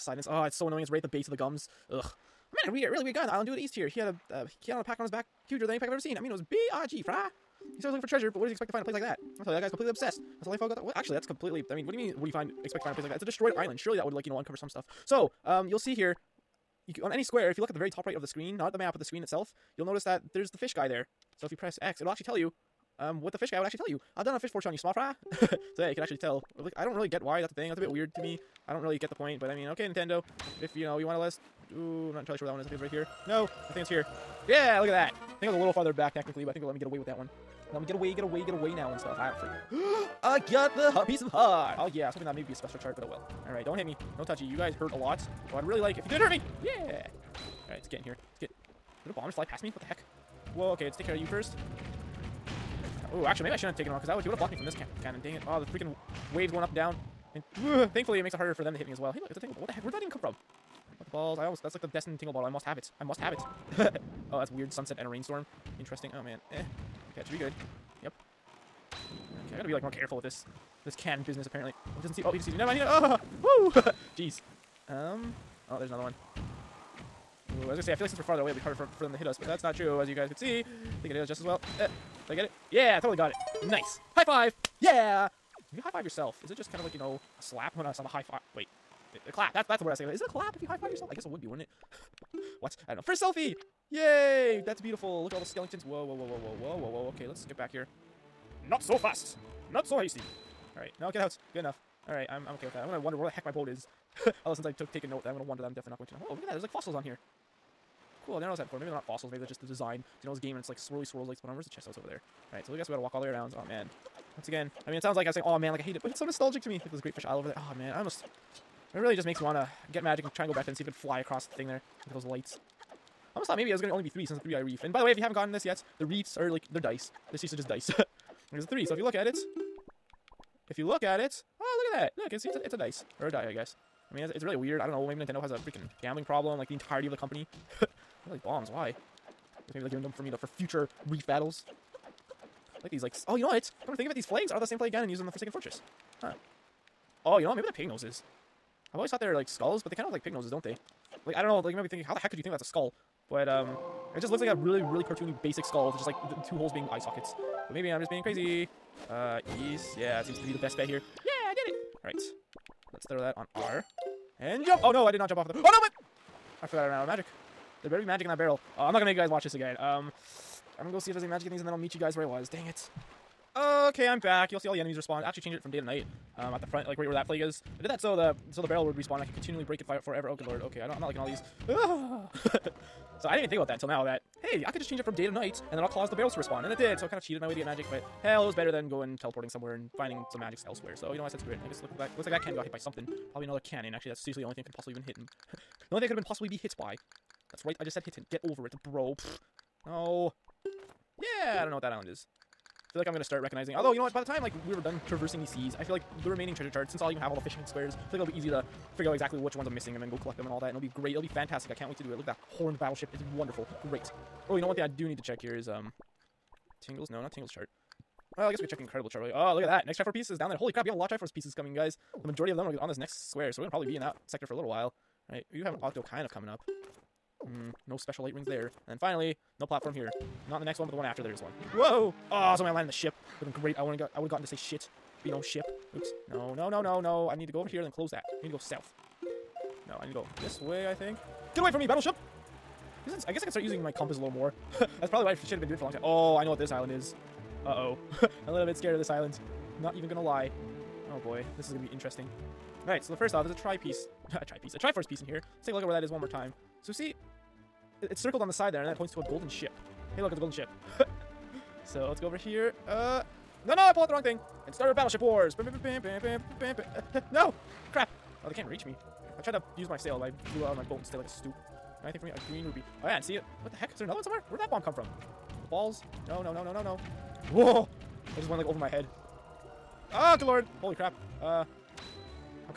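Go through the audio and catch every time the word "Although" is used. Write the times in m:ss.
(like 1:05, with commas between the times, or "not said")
1:44, 3:23.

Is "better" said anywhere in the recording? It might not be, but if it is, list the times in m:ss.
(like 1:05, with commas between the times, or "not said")
2:47, 3:08.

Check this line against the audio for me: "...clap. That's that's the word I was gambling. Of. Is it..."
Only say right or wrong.
wrong.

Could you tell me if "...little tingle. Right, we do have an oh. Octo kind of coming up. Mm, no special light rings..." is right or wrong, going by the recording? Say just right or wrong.
wrong.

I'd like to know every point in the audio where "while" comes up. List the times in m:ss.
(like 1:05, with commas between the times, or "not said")
3:44.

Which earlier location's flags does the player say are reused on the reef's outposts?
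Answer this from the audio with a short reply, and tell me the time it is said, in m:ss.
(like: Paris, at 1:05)
Forsaken Fortress, at 2:25.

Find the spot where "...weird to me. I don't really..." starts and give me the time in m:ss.
0:27.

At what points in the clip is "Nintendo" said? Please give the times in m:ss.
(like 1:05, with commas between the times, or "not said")
0:29, 2:15.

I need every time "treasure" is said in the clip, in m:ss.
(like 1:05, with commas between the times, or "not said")
0:08, 3:26.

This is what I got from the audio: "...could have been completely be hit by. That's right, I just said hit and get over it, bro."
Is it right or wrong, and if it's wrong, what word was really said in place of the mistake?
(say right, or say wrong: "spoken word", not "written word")
wrong: "possibly", not "completely".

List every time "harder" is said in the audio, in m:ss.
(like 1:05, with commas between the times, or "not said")
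0:58, 1:18.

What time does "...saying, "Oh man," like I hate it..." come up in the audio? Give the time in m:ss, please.
1:55.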